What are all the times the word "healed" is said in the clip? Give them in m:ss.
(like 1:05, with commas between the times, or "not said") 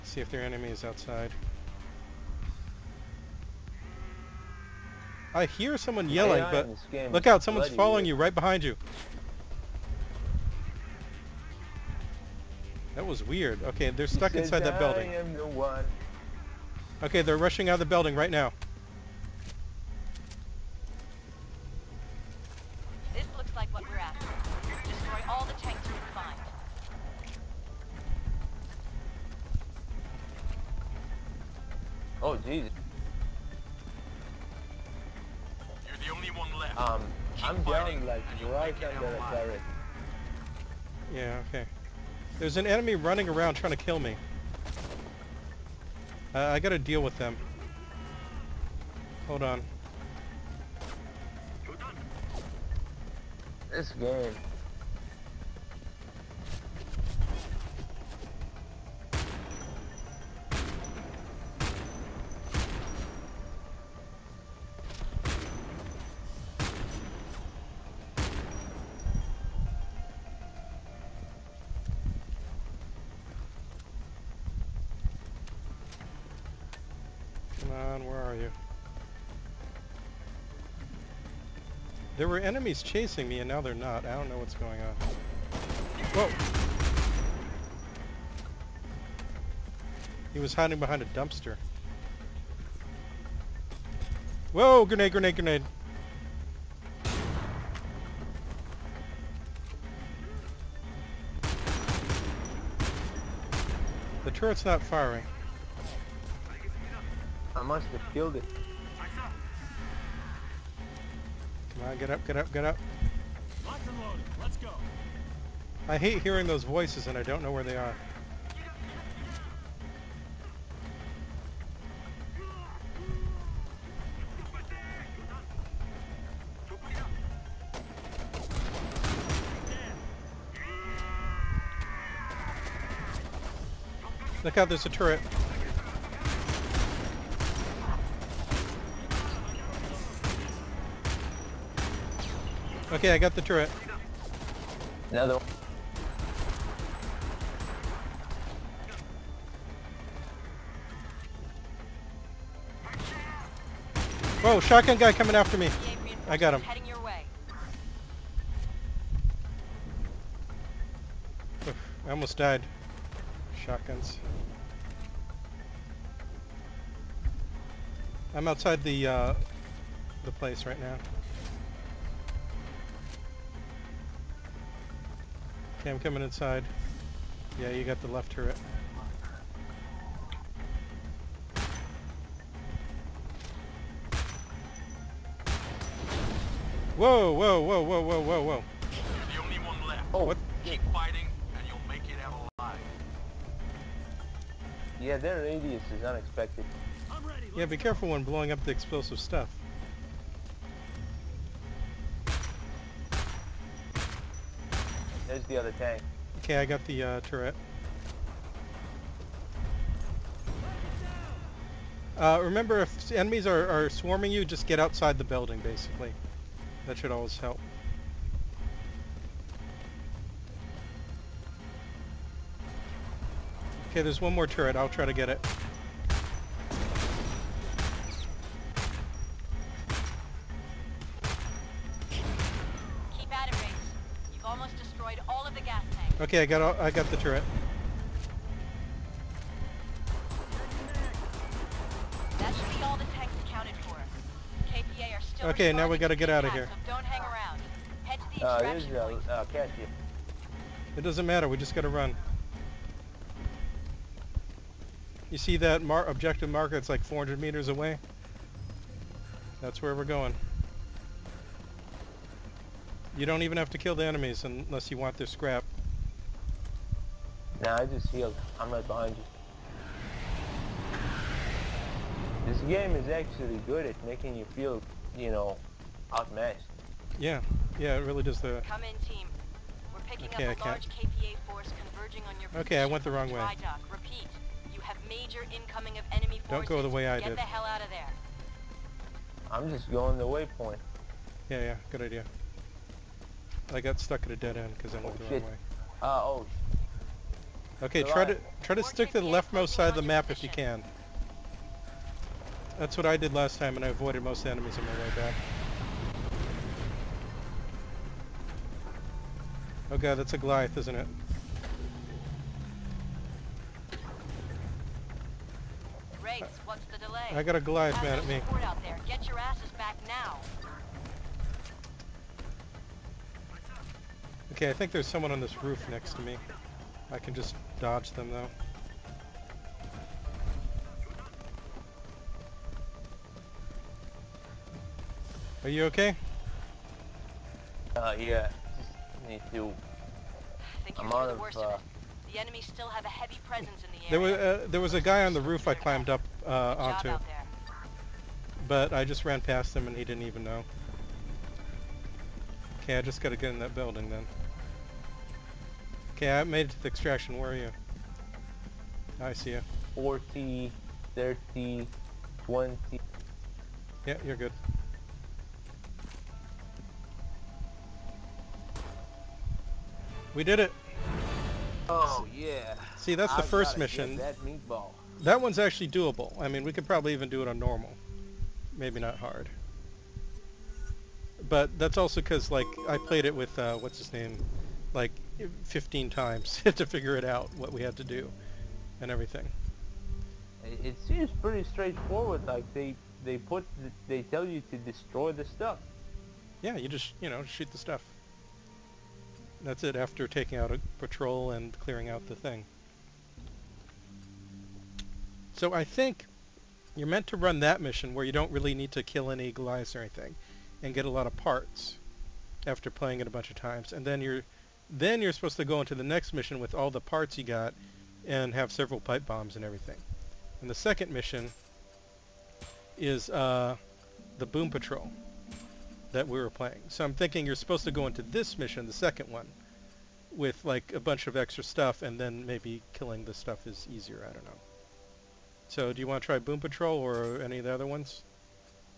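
4:28.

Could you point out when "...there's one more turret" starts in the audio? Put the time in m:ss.
3:44.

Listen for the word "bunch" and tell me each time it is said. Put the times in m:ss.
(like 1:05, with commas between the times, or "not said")
6:53, 7:10.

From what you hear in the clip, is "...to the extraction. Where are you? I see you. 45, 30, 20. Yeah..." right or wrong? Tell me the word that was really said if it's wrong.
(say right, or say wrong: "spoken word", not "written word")
wrong: "40", not "45".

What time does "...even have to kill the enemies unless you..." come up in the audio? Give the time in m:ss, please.
4:23.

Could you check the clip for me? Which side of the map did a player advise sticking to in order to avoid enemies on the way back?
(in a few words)
Leftmost side.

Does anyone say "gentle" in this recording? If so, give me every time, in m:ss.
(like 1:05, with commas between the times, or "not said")
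not said.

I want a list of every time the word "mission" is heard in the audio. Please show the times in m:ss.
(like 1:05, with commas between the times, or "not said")
6:13, 6:47, 6:56, 7:01, 7:08.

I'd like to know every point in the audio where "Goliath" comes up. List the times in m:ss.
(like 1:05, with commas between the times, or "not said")
5:10, 5:17, 6:49.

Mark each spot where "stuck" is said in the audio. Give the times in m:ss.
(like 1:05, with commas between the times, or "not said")
0:14, 4:54.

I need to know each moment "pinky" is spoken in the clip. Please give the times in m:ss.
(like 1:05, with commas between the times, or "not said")
not said.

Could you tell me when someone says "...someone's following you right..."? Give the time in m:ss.
0:07.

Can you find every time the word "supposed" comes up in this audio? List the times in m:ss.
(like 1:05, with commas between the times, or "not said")
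6:55, 7:07.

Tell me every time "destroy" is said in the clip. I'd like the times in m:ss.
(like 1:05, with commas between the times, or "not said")
0:24, 6:34.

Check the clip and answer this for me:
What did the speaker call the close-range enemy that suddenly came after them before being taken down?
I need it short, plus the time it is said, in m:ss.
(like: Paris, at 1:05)
Shotgun guy, at 2:34.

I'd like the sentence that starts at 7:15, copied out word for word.
So do you want to try Boom Patrol or any of the other ones?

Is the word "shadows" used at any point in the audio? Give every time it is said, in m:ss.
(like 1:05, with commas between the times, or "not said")
not said.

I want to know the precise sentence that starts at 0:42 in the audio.
There's an enemy running around trying to kill me.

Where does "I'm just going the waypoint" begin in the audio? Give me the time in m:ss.
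4:49.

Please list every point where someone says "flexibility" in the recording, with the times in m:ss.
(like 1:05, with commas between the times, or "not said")
not said.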